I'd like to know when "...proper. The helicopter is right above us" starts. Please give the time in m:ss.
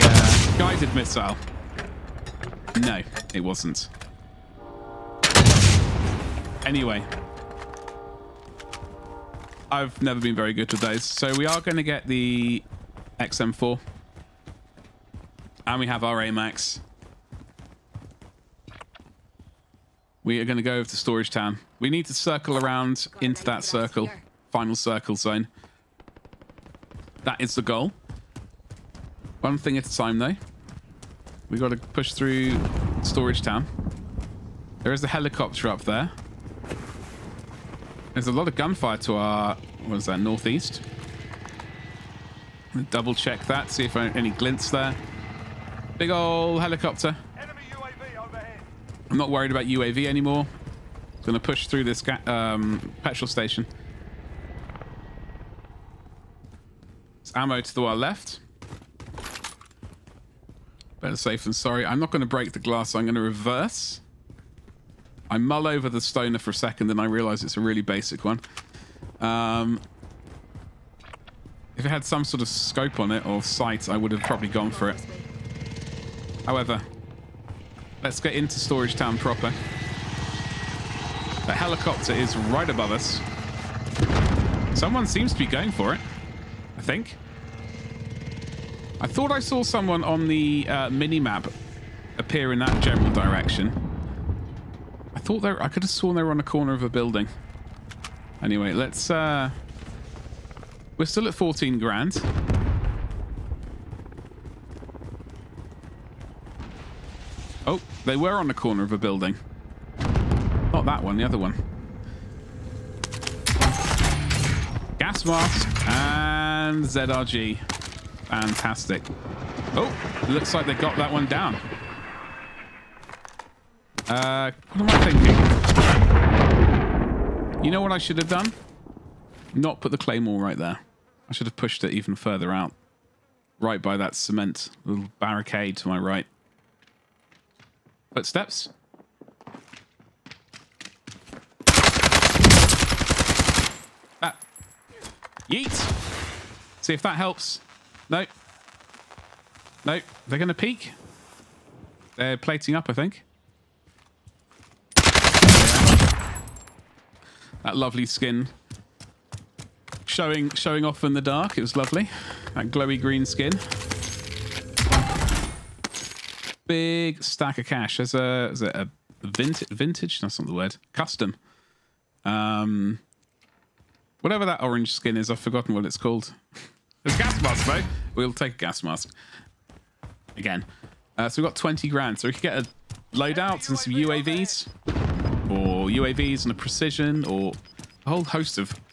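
1:19.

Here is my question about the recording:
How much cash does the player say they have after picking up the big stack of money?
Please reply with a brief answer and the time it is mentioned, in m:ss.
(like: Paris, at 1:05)
20 grand, at 3:01.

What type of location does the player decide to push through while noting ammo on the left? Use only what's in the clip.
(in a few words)
petrol station.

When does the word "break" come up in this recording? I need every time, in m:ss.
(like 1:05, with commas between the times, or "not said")
1:02.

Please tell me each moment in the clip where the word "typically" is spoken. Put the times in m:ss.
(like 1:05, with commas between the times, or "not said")
not said.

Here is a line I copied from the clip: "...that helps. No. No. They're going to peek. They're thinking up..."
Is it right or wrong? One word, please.
wrong.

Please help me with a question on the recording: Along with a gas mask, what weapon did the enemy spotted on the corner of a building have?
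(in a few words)
ZRG.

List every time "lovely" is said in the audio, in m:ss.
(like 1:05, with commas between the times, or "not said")
2:37, 2:41.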